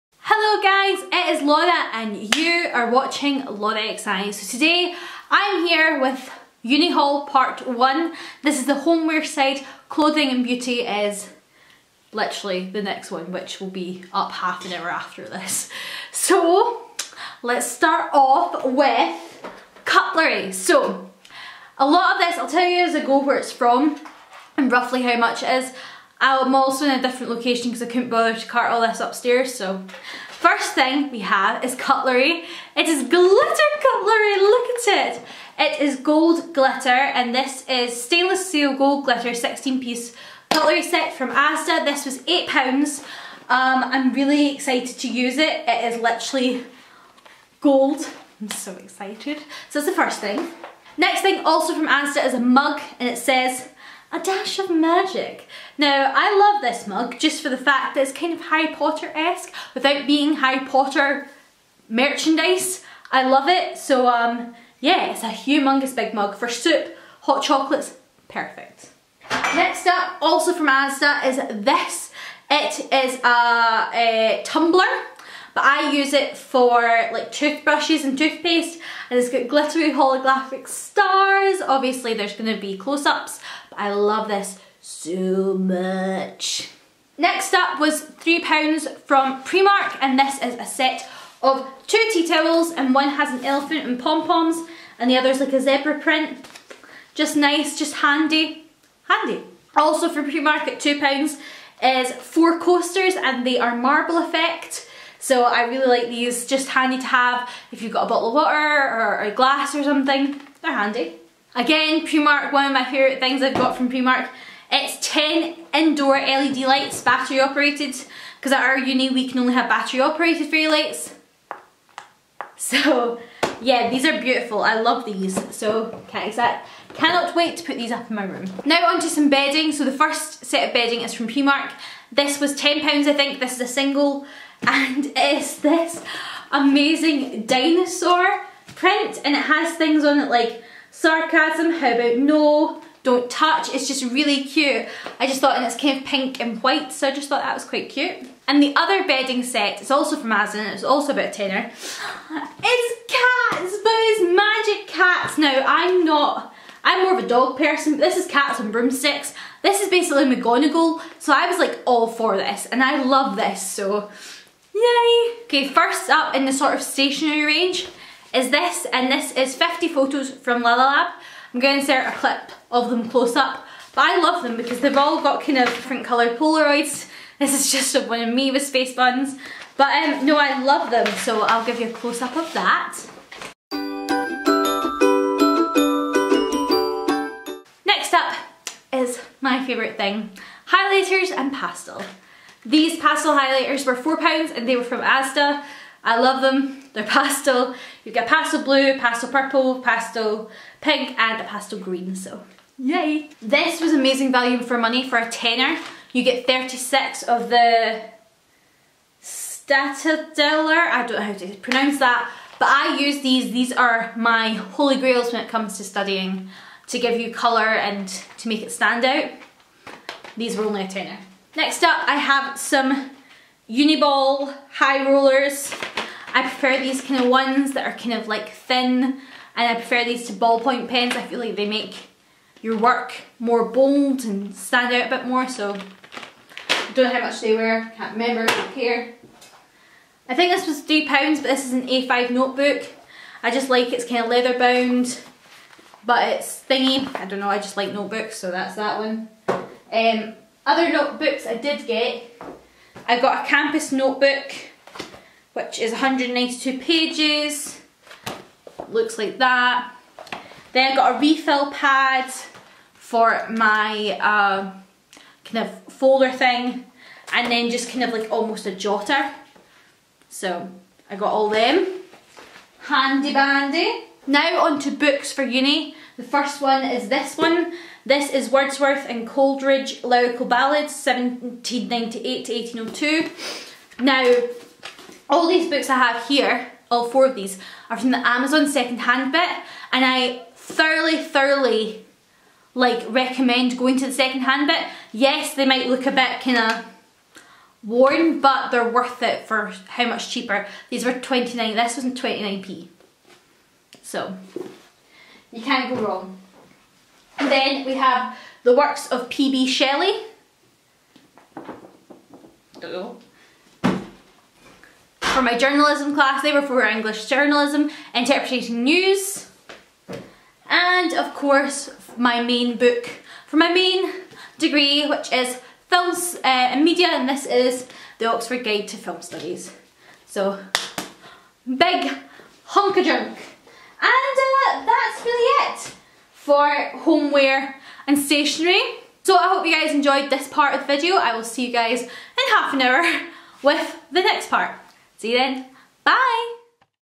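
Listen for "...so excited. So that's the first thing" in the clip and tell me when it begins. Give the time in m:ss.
0:48.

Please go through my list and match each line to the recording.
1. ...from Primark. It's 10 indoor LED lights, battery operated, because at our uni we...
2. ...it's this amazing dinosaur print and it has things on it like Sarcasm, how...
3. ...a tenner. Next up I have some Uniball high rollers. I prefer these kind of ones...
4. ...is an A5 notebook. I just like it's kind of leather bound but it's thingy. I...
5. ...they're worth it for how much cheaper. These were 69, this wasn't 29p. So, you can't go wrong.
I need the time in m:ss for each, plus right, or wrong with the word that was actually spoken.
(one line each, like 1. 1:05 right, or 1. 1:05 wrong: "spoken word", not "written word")
1. 1:53 right
2. 2:15 right
3. 3:40 right
4. 4:01 right
5. 4:58 wrong: "29", not "69".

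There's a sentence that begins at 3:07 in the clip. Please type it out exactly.
Next up is my favourite thing, highlighters and pastel.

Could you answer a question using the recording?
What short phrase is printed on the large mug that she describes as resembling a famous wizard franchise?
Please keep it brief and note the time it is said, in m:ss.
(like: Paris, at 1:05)
a dash of magic, at 0:54.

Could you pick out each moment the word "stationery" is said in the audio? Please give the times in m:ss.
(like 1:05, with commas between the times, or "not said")
2:46, 5:38.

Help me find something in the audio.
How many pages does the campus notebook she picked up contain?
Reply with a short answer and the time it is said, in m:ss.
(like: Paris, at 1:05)
192, at 4:15.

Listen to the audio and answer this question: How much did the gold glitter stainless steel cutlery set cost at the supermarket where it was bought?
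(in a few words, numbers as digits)
£8.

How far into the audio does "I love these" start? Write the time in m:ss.
2:04.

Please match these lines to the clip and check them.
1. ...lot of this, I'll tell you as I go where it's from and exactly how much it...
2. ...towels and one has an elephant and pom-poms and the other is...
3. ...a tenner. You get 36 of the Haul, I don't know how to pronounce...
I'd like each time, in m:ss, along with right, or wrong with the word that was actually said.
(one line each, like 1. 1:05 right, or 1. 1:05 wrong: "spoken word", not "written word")
1. 0:21 wrong: "roughly", not "exactly"
2. 1:32 right
3. 3:25 wrong: "Staedtler", not "Haul".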